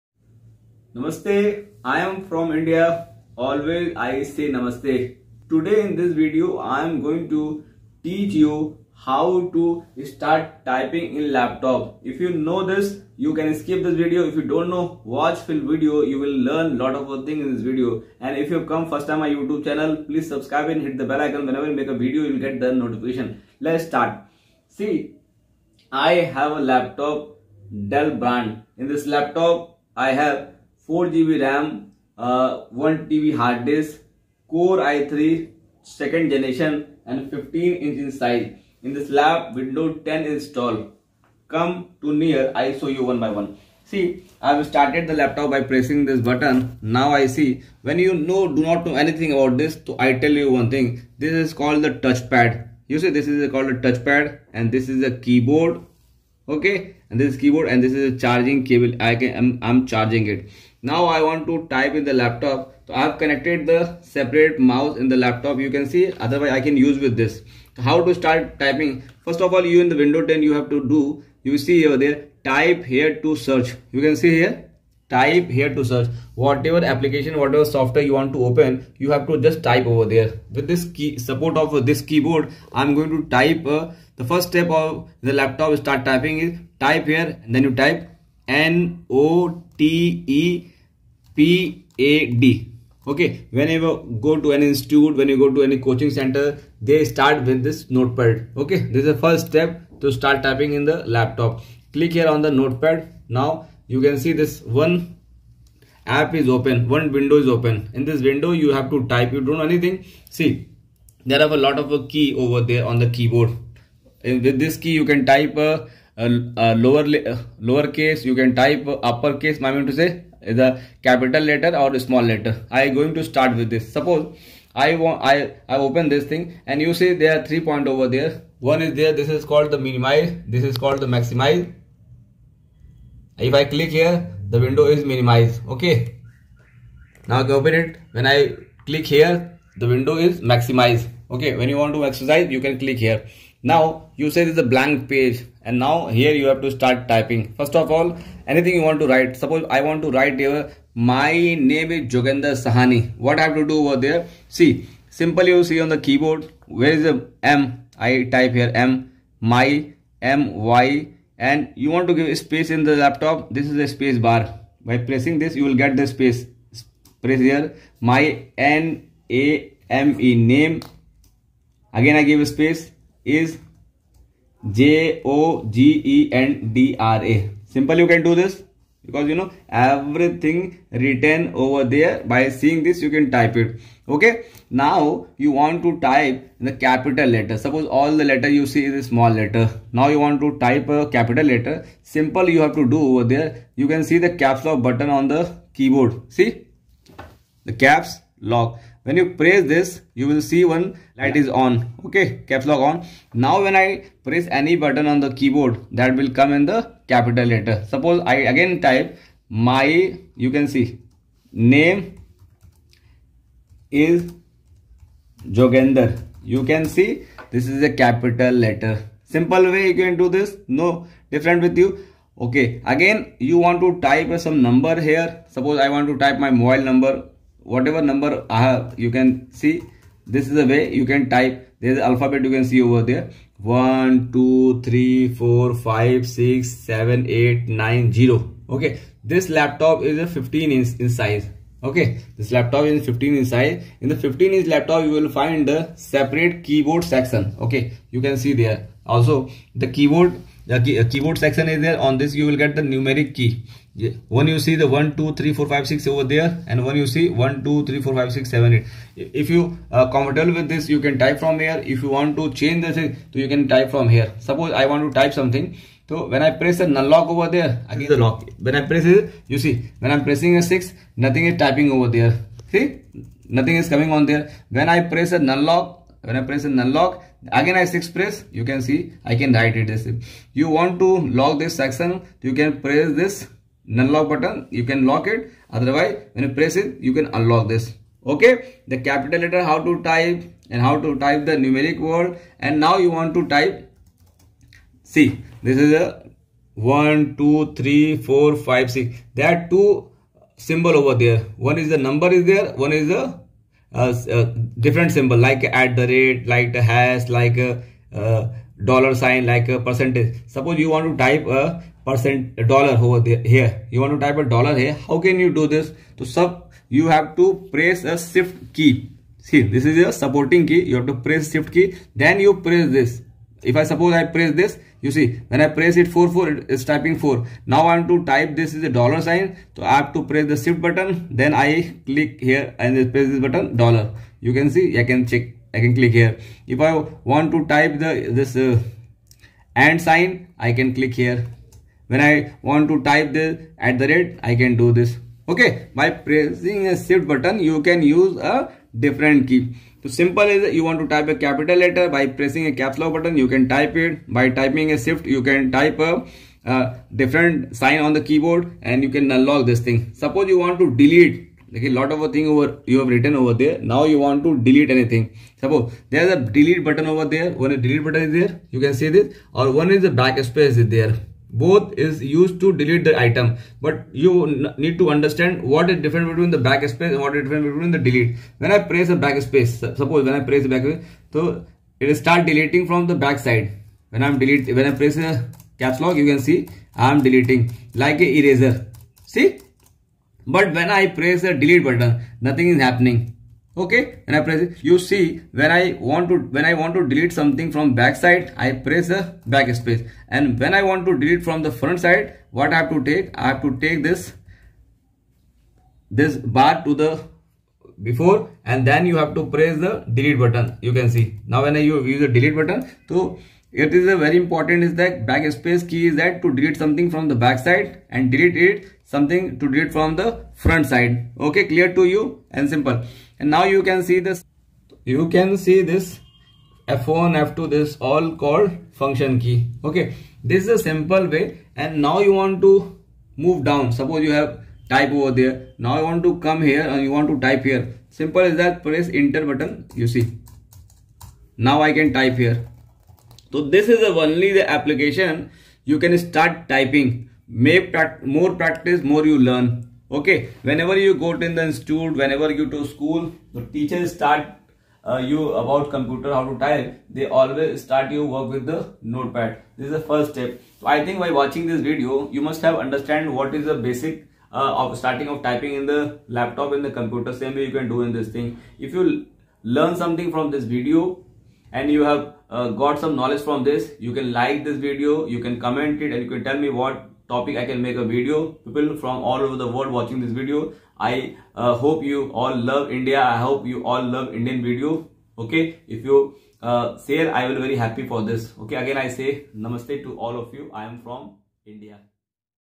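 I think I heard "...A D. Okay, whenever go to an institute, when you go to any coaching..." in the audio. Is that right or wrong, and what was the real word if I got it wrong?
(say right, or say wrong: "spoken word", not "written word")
right.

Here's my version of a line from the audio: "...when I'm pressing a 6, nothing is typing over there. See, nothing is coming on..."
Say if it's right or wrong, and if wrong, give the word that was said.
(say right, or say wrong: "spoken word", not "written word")
right.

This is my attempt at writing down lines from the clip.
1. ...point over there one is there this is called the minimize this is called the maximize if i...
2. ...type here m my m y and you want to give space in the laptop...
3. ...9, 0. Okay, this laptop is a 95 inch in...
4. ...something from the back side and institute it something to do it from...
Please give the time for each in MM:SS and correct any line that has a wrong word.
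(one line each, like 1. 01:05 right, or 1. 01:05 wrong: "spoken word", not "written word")
1. 02:07 right
2. 02:38 right
3. 03:57 wrong: "15", not "95"
4. 06:56 wrong: "delete", not "institute".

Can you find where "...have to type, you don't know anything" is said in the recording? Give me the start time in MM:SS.
01:48.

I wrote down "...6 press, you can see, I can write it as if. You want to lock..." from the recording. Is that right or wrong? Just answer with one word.
right.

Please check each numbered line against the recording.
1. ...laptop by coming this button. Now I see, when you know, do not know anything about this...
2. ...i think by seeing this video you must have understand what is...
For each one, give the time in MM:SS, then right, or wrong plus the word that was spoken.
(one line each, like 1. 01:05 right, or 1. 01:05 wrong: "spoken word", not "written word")
1. 00:45 wrong: "pressing", not "coming"
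2. 07:40 wrong: "watching", not "seeing".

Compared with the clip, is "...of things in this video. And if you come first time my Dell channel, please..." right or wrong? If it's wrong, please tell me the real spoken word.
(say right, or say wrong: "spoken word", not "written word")
wrong: "YouTube", not "Dell".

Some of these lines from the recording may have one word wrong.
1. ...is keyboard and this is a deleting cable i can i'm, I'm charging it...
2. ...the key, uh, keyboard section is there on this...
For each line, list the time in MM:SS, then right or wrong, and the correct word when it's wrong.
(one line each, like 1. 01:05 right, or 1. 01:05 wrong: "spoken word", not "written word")
1. 00:57 wrong: "charging", not "deleting"
2. 04:10 right.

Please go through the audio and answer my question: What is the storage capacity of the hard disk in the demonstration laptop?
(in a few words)
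1 TB.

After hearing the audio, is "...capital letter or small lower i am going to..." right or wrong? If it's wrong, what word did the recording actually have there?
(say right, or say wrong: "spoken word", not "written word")
wrong: "letter", not "lower".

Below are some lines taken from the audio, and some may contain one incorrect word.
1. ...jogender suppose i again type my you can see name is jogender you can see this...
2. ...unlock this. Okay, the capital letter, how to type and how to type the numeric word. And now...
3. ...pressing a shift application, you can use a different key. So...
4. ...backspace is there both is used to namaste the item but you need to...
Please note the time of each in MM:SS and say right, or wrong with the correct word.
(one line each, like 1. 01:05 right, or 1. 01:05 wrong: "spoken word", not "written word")
1. 03:27 wrong: "letter", not "jogender"
2. 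04:47 right
3. 05:46 wrong: "button", not "application"
4. 06:10 wrong: "delete", not "namaste".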